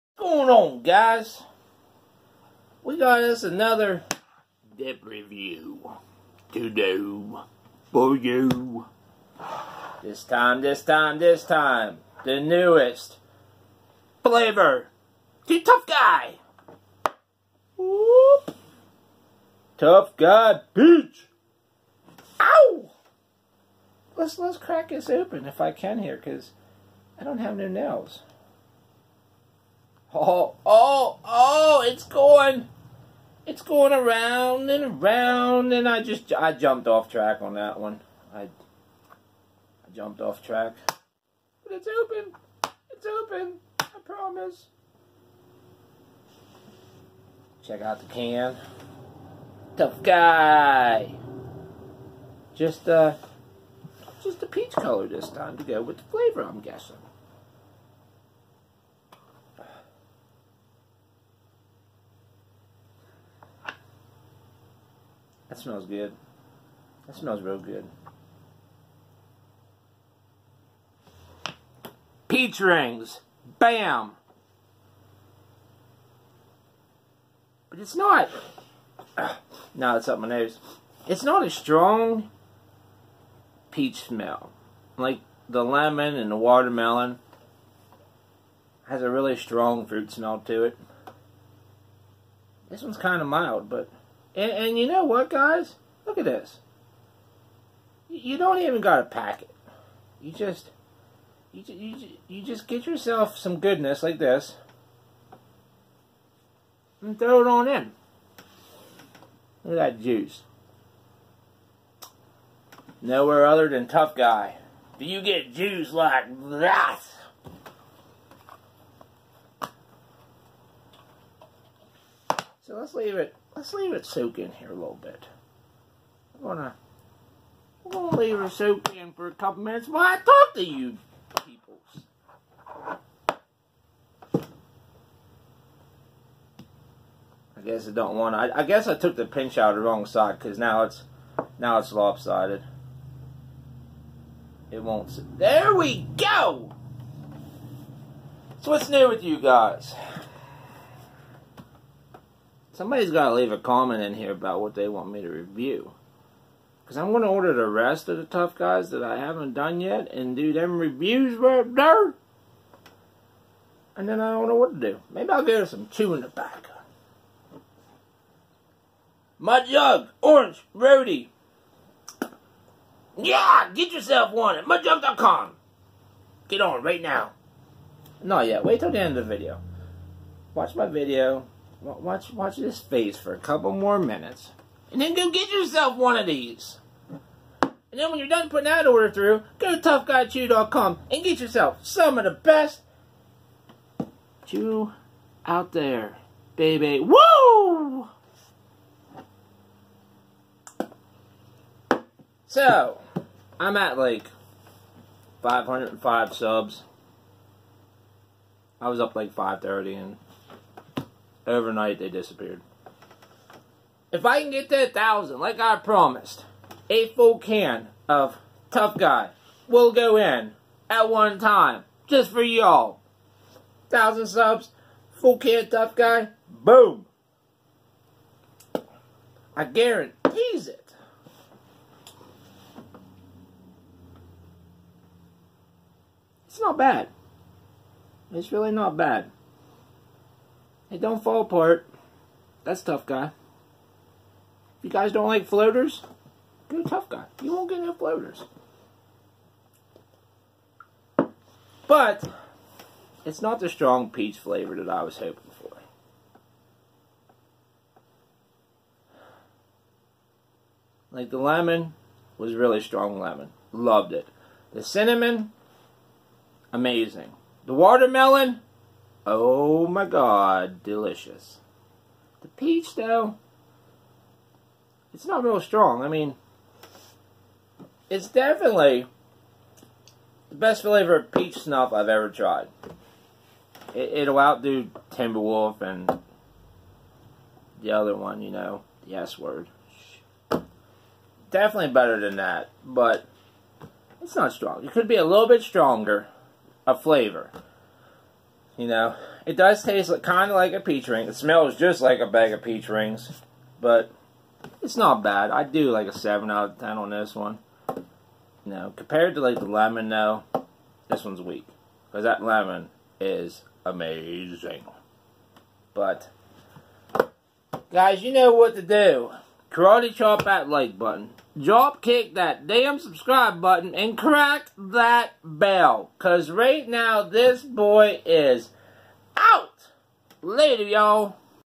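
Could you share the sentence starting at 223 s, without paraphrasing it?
Thousand subs, full can Tough Guy, boom.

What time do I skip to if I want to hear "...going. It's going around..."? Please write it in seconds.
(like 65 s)
32 s.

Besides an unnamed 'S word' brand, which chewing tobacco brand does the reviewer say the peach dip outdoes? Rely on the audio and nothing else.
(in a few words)
Timberwolf.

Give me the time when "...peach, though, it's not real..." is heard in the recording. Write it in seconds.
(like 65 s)
272 s.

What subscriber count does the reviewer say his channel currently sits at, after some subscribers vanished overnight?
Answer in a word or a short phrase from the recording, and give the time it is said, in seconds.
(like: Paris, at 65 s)
505, at 205 s.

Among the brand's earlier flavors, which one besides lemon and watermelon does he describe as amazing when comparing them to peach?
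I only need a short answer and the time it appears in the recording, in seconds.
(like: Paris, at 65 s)
Cinnamon, at 264 s.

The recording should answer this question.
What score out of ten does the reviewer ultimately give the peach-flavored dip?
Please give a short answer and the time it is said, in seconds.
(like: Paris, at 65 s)
7, at 306 s.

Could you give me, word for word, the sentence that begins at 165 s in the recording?
Maybe I'll get some chewing tobacco.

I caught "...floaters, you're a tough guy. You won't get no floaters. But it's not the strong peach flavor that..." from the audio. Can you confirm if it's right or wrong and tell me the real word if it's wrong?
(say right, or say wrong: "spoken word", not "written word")
right.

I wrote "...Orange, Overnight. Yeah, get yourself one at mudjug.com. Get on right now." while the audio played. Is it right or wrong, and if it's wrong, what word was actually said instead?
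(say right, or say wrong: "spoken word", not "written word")
wrong: "Rarity", not "Overnight".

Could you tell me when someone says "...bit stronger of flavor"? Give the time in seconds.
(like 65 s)
295 s.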